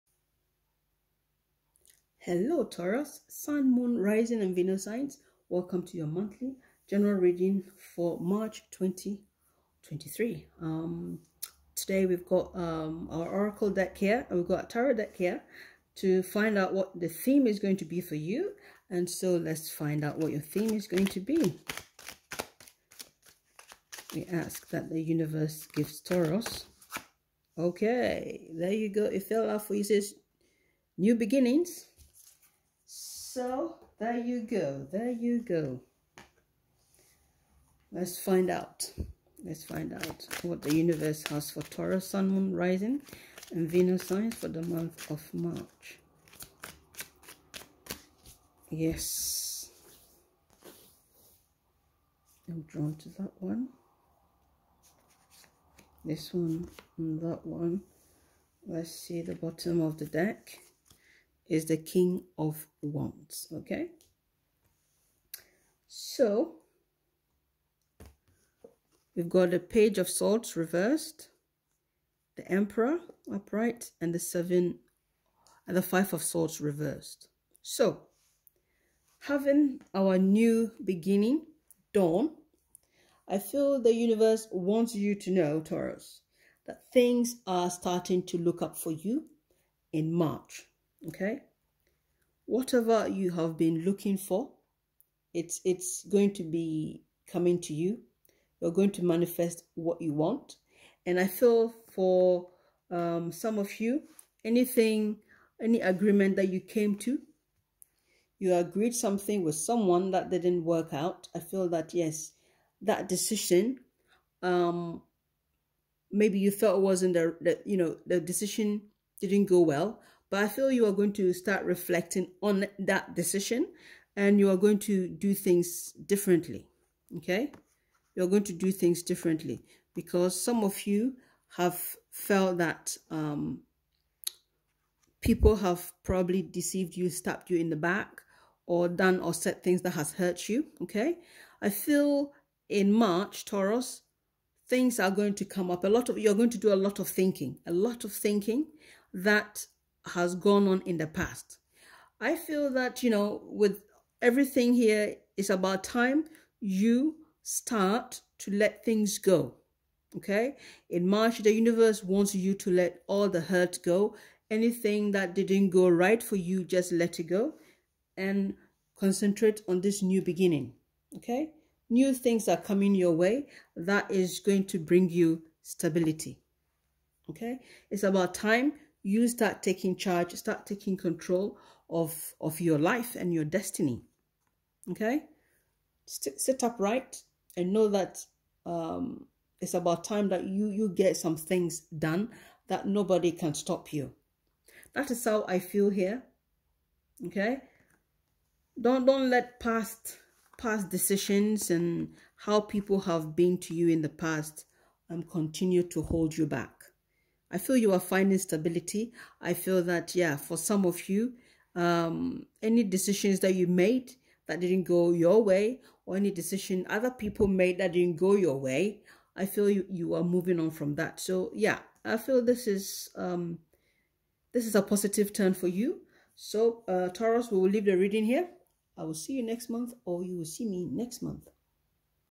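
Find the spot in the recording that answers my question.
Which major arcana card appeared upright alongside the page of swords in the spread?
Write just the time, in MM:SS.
01:12.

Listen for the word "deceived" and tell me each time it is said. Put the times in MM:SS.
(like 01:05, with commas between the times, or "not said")
02:16.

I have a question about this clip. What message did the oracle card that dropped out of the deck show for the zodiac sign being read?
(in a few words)
New beginnings.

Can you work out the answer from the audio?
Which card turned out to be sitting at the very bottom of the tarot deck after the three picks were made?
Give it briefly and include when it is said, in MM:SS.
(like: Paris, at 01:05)
King of Wands, at 01:01.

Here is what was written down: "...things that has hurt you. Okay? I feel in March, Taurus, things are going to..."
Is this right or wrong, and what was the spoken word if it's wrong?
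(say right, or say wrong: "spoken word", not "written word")
right.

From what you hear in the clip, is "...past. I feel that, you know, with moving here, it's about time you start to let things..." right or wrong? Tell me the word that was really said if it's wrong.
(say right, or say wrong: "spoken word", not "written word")
wrong: "everything", not "moving".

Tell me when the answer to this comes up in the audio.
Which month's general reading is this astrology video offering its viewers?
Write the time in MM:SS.
00:08.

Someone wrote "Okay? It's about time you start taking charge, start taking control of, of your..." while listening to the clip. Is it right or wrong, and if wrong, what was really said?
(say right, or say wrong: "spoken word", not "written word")
right.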